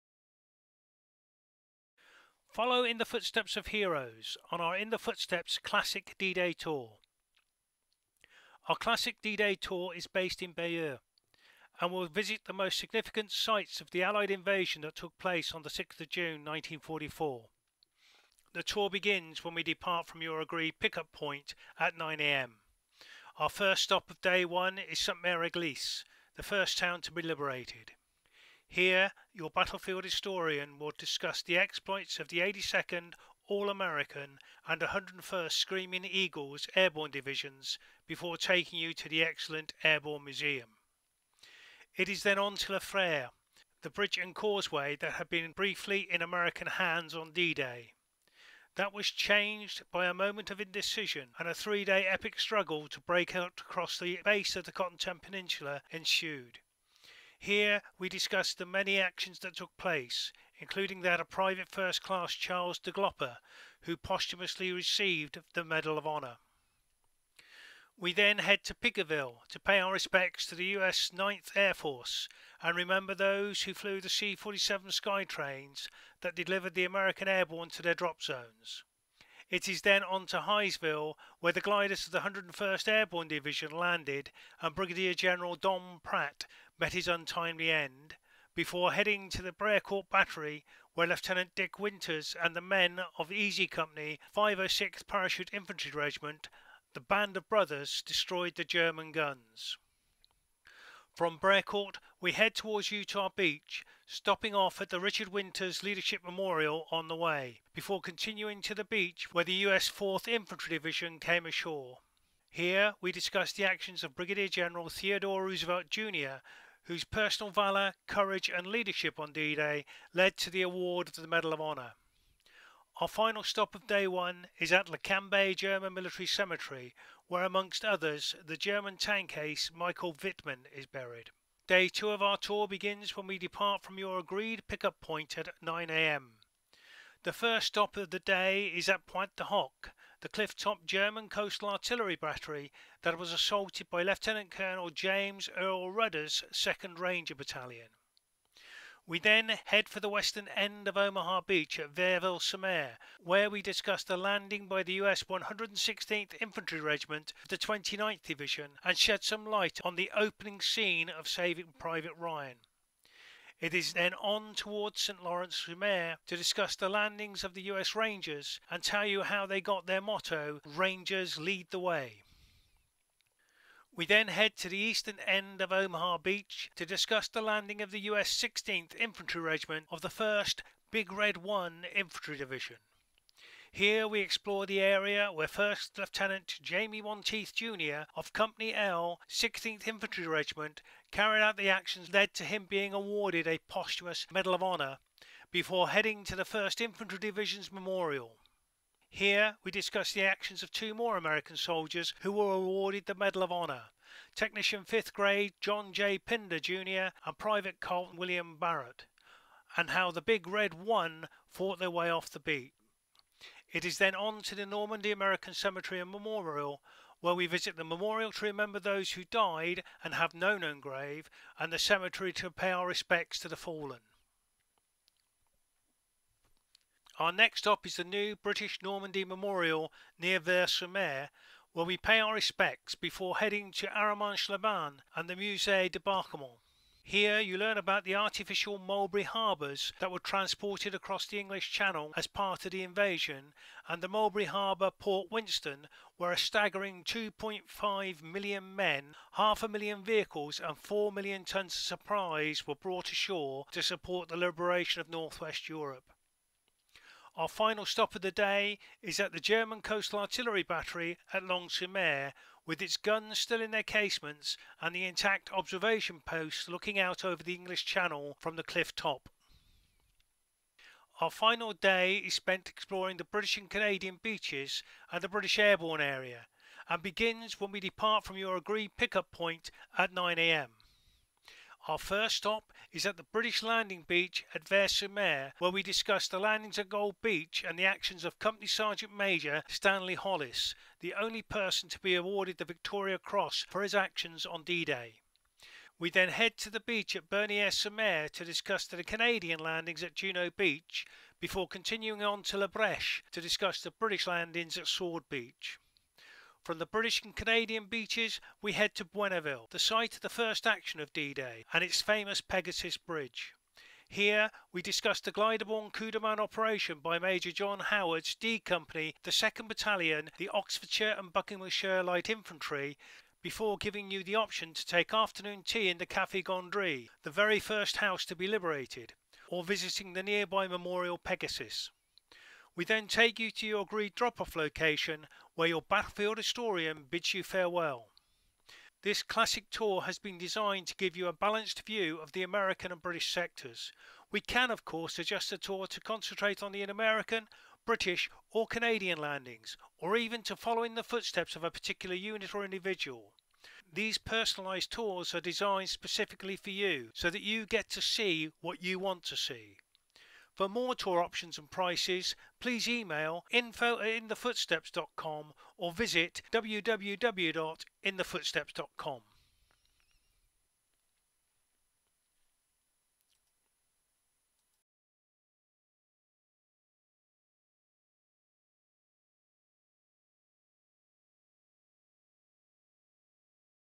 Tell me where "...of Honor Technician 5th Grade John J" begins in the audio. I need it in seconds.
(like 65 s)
203 s.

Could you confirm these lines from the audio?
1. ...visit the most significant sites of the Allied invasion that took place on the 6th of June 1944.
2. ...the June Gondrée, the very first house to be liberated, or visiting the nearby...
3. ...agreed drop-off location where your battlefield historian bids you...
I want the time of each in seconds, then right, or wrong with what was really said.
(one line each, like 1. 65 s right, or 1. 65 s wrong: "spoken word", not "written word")
1. 12 s right
2. 325 s wrong: "Café", not "June"
3. 333 s right.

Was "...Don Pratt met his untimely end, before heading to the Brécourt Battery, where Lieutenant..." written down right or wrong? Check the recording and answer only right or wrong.
right.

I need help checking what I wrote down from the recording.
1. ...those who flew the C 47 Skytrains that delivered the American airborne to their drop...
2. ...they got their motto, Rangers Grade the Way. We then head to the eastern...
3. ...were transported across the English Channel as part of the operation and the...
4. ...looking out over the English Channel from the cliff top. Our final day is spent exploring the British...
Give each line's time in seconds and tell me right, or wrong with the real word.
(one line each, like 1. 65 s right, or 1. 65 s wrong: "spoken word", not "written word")
1. 73 s right
2. 169 s wrong: "Lead", not "Grade"
3. 240 s wrong: "invasion", not "operation"
4. 266 s right.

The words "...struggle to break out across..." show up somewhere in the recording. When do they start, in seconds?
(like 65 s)
52 s.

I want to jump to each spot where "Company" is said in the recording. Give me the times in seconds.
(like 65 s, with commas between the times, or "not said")
93 s, 188 s, 288 s, 318 s.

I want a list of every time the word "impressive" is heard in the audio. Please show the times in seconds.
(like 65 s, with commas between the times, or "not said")
not said.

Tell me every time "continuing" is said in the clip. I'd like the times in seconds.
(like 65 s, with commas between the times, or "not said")
108 s, 301 s.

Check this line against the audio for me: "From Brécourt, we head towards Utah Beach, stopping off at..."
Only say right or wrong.
right.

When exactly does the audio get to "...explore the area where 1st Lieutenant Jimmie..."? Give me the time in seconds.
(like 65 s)
184 s.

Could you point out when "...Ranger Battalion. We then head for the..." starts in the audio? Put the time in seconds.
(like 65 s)
146 s.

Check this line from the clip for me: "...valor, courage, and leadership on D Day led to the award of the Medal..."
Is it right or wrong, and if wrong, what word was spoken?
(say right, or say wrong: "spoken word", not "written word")
right.